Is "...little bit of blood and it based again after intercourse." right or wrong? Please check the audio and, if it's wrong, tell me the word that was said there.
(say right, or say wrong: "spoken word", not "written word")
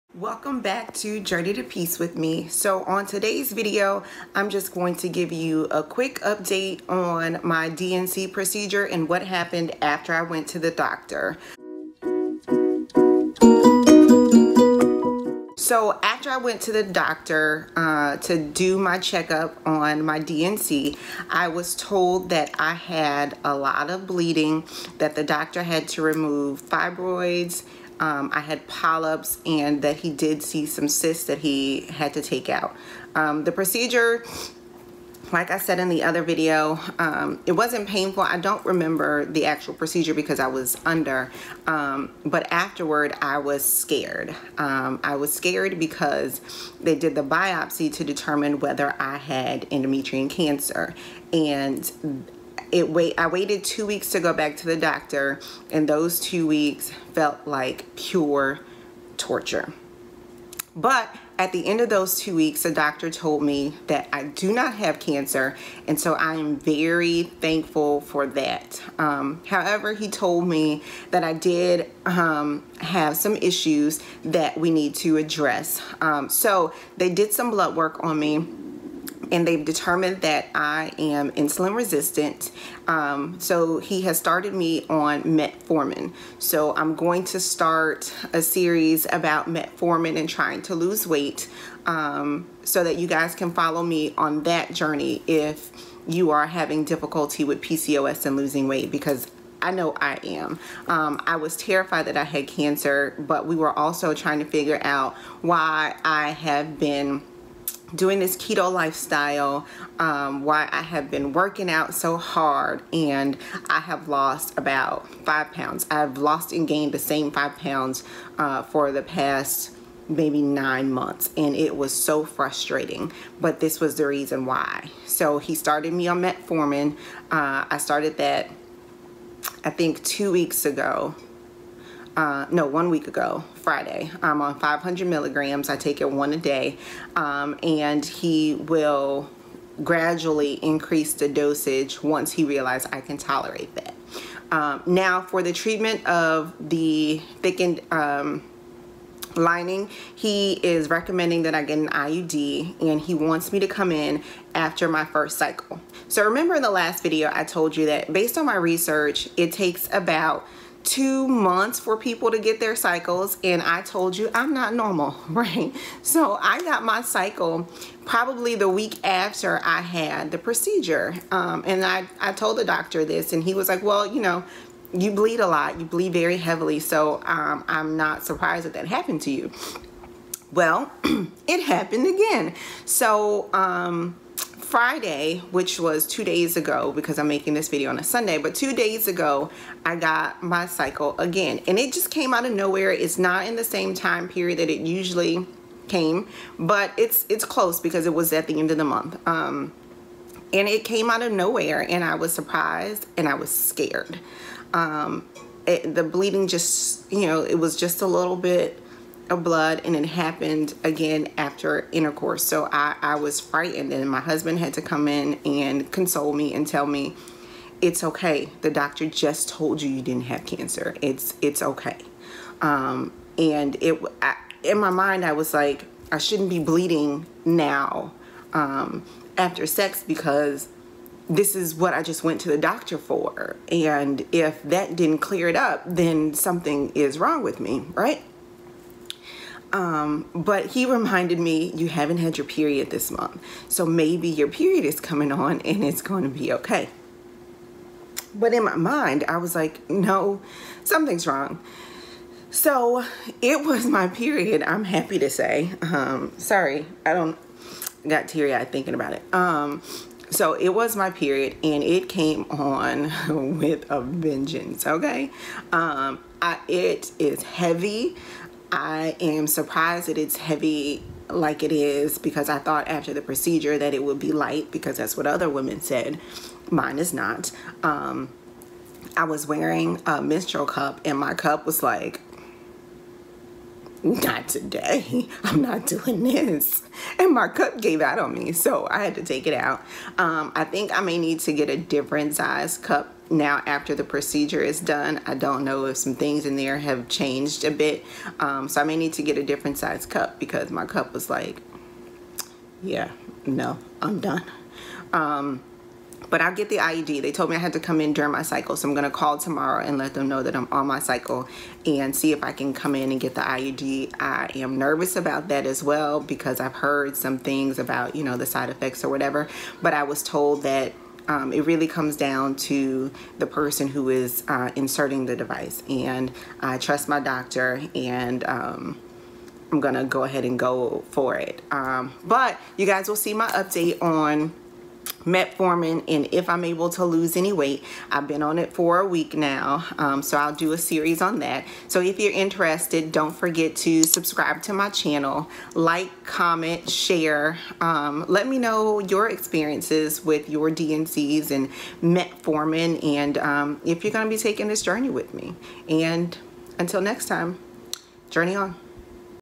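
wrong: "happened", not "based".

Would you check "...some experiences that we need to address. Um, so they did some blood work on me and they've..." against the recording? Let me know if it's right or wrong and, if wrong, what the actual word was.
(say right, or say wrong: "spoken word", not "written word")
wrong: "issues", not "experiences".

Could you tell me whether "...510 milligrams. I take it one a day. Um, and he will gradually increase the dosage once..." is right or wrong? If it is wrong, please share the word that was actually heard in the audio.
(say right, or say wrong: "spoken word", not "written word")
wrong: "500", not "510".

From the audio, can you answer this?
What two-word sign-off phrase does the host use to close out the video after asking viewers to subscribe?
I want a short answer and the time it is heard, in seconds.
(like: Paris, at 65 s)
journey on, at 358 s.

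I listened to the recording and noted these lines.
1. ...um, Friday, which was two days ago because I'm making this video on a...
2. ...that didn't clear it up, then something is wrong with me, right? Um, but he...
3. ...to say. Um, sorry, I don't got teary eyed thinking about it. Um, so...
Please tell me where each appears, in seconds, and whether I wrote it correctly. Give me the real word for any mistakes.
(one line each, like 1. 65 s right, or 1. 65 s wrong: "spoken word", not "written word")
1. 183 s right
2. 234 s right
3. 255 s right.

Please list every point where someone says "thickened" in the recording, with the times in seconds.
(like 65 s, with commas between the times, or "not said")
147 s.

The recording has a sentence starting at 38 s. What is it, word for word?
I don't remember the actual procedure because I was under, um, but afterward I was scared.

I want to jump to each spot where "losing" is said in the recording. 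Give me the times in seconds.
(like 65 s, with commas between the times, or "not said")
98 s.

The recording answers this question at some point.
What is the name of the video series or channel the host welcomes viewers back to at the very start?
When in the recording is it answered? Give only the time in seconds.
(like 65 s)
1 s.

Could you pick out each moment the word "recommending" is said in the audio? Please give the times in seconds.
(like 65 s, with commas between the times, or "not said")
150 s.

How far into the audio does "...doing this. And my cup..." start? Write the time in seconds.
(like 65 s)
285 s.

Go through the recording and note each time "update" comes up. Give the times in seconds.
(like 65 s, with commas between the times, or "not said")
6 s, 333 s.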